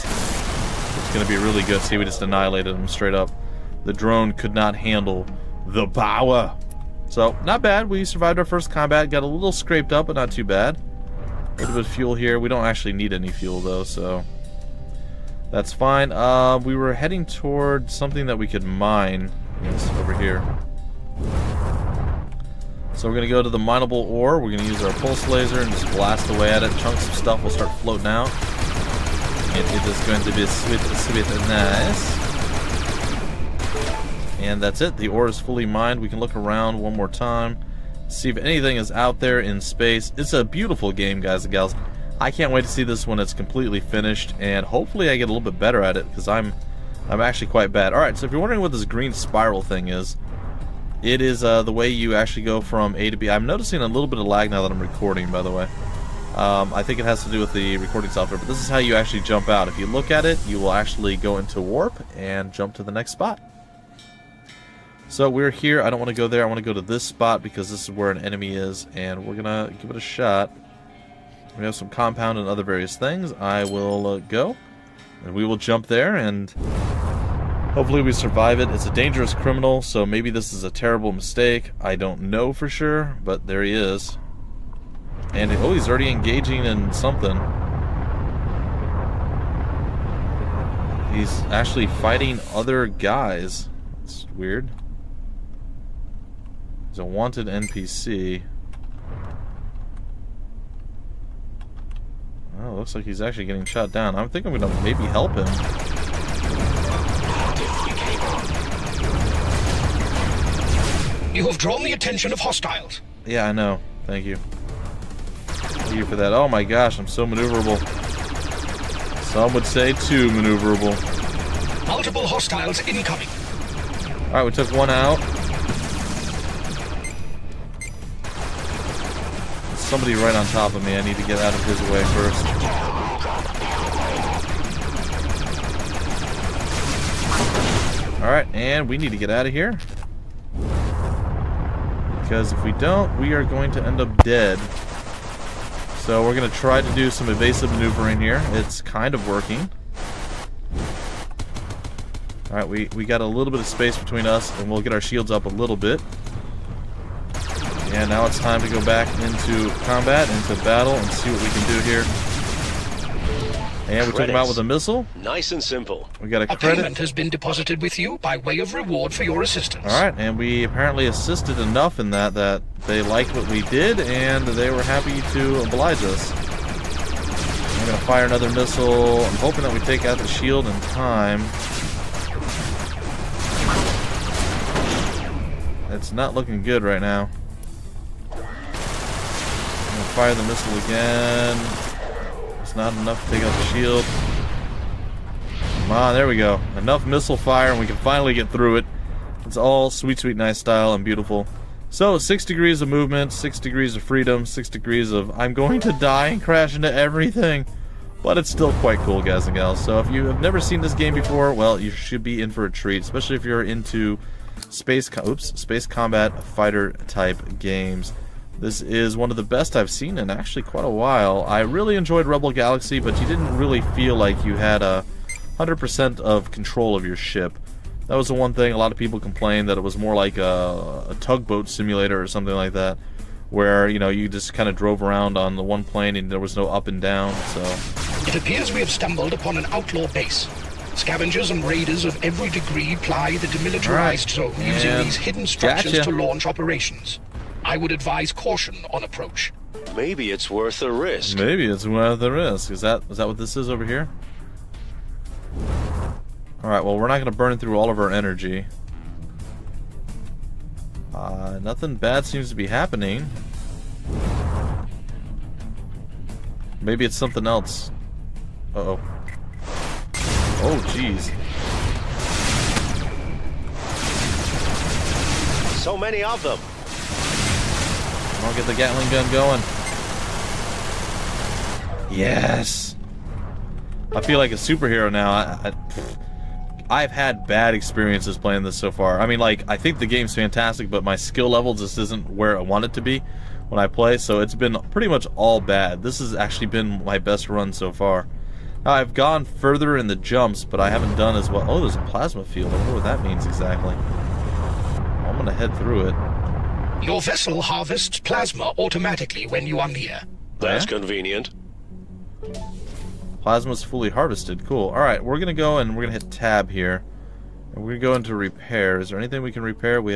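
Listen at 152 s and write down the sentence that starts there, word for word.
Alright, we, we got a little bit of space between us, and we'll get our shields up a little bit.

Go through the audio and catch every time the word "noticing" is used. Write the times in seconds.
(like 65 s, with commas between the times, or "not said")
53 s.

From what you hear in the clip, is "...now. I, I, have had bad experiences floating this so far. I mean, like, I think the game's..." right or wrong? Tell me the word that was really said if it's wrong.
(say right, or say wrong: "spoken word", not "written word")
wrong: "playing", not "floating".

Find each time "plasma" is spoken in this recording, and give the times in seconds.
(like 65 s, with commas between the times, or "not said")
302 s, 308 s, 313 s.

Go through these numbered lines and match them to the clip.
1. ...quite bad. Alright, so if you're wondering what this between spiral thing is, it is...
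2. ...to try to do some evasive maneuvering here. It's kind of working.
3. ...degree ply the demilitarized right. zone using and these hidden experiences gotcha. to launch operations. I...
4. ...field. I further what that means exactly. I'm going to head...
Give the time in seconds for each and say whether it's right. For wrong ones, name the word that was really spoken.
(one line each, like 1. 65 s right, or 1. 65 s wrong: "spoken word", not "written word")
1. 47 s wrong: "green", not "between"
2. 146 s right
3. 242 s wrong: "structures", not "experiences"
4. 302 s wrong: "wonder", not "further".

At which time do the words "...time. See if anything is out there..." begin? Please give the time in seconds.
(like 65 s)
37 s.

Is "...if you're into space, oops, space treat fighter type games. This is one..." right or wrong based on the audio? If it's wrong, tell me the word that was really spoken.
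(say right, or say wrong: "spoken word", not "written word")
wrong: "combat", not "treat".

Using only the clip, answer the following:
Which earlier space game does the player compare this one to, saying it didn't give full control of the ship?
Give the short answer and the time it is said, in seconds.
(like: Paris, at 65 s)
Rebel Galaxy, at 222 s.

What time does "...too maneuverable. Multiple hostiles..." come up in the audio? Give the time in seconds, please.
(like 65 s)
119 s.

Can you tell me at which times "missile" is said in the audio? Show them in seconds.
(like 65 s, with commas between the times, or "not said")
164 s, 178 s, 190 s, 197 s.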